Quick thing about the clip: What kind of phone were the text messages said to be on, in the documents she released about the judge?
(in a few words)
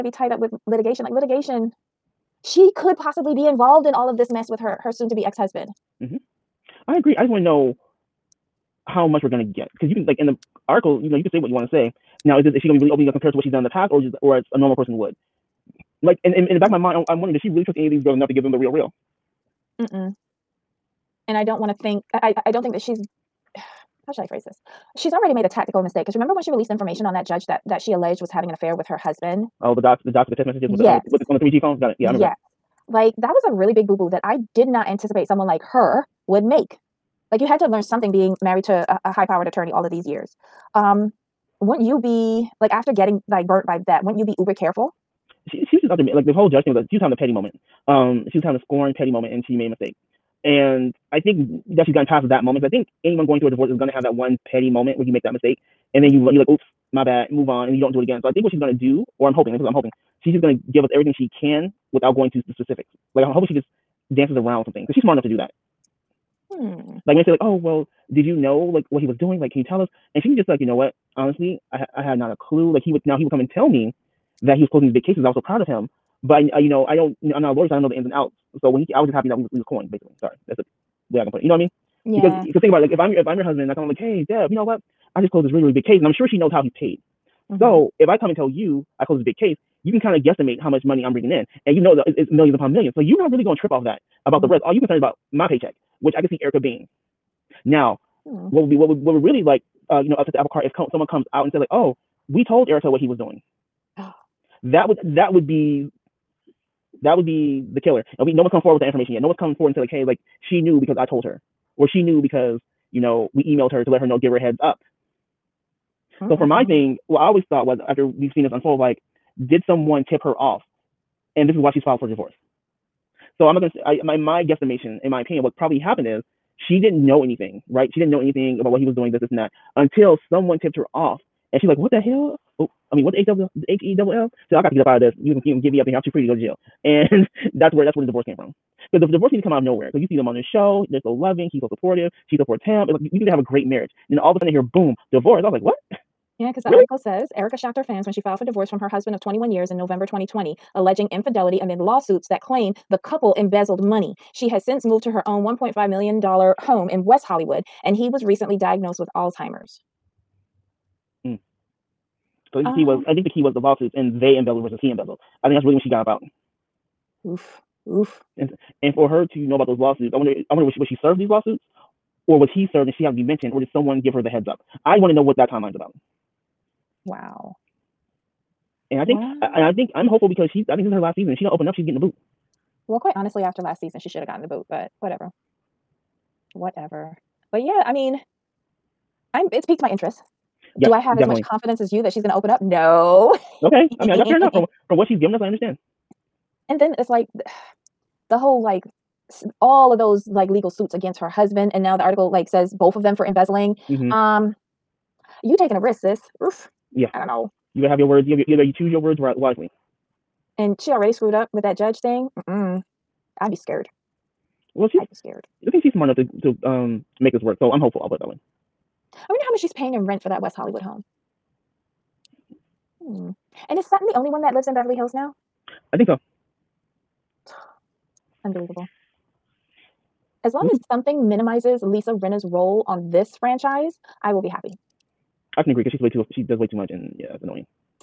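3G phone.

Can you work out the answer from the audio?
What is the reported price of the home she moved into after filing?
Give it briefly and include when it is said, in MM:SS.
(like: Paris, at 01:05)
$1.5 million, at 02:35.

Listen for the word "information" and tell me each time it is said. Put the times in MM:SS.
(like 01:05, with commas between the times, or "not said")
00:26, 01:48.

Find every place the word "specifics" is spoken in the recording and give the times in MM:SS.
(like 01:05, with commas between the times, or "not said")
01:02.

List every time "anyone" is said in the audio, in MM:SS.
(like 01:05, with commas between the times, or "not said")
00:53.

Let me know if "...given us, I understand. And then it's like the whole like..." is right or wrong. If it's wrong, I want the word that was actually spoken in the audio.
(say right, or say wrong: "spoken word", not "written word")
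right.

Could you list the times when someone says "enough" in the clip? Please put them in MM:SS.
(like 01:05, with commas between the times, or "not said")
00:18, 01:05, 03:14, 03:36.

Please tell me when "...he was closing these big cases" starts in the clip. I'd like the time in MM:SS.
01:14.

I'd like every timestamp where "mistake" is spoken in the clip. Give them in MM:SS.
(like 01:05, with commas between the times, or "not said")
00:25, 00:49, 00:55.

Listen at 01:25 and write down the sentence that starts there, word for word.
I just closed this really, really big case and I'm sure she knows how he's paid.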